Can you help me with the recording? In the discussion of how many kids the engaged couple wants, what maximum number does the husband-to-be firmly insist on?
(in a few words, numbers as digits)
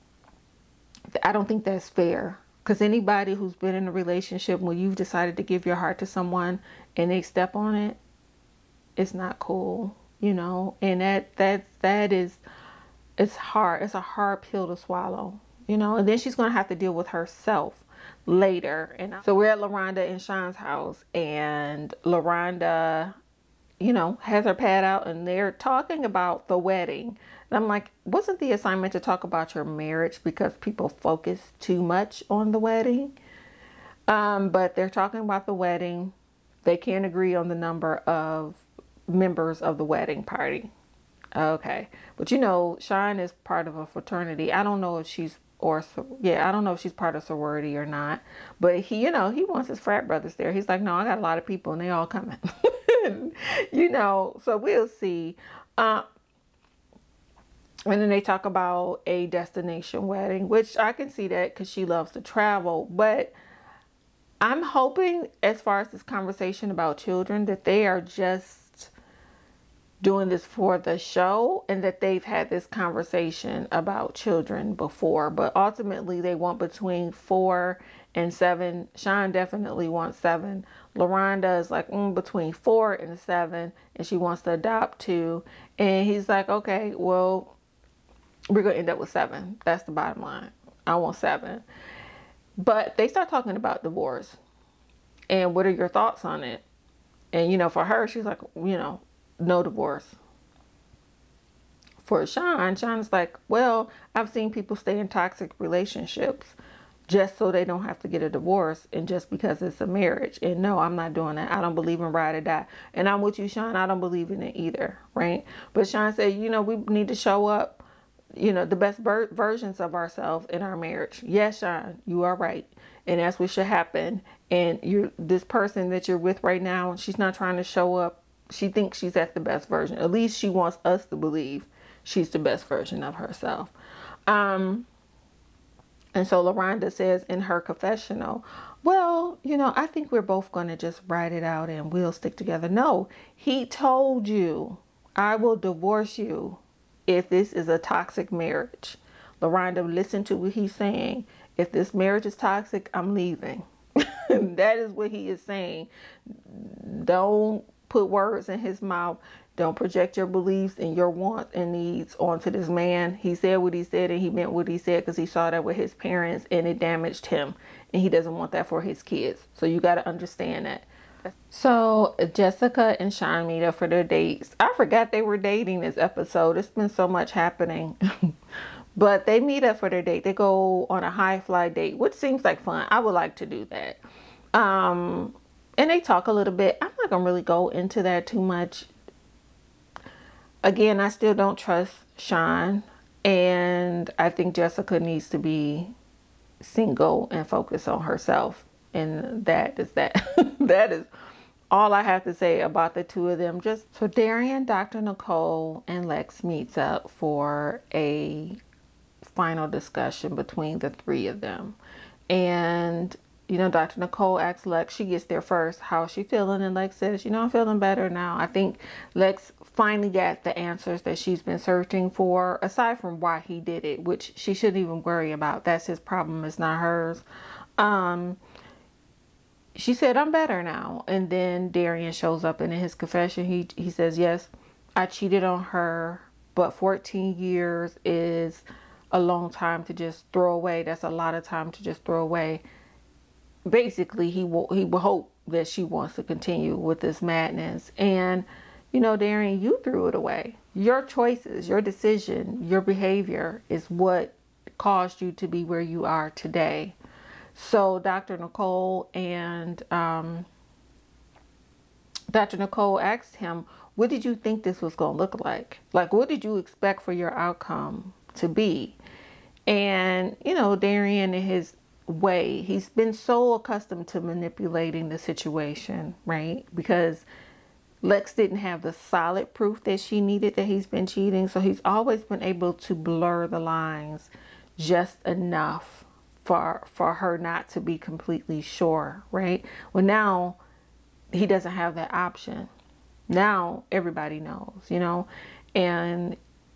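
7.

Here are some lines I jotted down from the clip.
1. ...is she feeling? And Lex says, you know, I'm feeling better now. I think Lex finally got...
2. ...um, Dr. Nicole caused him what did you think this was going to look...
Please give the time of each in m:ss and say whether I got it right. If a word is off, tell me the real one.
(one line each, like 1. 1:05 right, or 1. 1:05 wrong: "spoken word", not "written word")
1. 3:36 right
2. 4:19 wrong: "asked", not "caused".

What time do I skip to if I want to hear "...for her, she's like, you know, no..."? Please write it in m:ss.
1:37.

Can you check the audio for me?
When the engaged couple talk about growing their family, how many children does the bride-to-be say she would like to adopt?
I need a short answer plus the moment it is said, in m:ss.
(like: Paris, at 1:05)
2, at 1:24.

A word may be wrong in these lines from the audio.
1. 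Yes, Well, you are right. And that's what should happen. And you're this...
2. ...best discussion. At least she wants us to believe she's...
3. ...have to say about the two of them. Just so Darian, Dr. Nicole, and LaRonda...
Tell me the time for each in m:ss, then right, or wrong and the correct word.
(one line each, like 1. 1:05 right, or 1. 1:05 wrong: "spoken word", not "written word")
1. 2:01 wrong: "Sean", not "Well"
2. 2:09 wrong: "version", not "discussion"
3. 3:22 wrong: "Lex", not "LaRonda".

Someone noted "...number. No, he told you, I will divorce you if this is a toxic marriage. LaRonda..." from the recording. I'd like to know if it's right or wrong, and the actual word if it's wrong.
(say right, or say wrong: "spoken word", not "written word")
wrong: "together", not "number".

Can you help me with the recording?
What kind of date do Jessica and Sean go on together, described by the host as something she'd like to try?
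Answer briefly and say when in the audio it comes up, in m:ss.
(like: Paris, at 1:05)
High fly date, at 3:01.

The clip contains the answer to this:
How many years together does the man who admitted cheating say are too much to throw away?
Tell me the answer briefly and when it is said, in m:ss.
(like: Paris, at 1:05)
14 years, at 3:56.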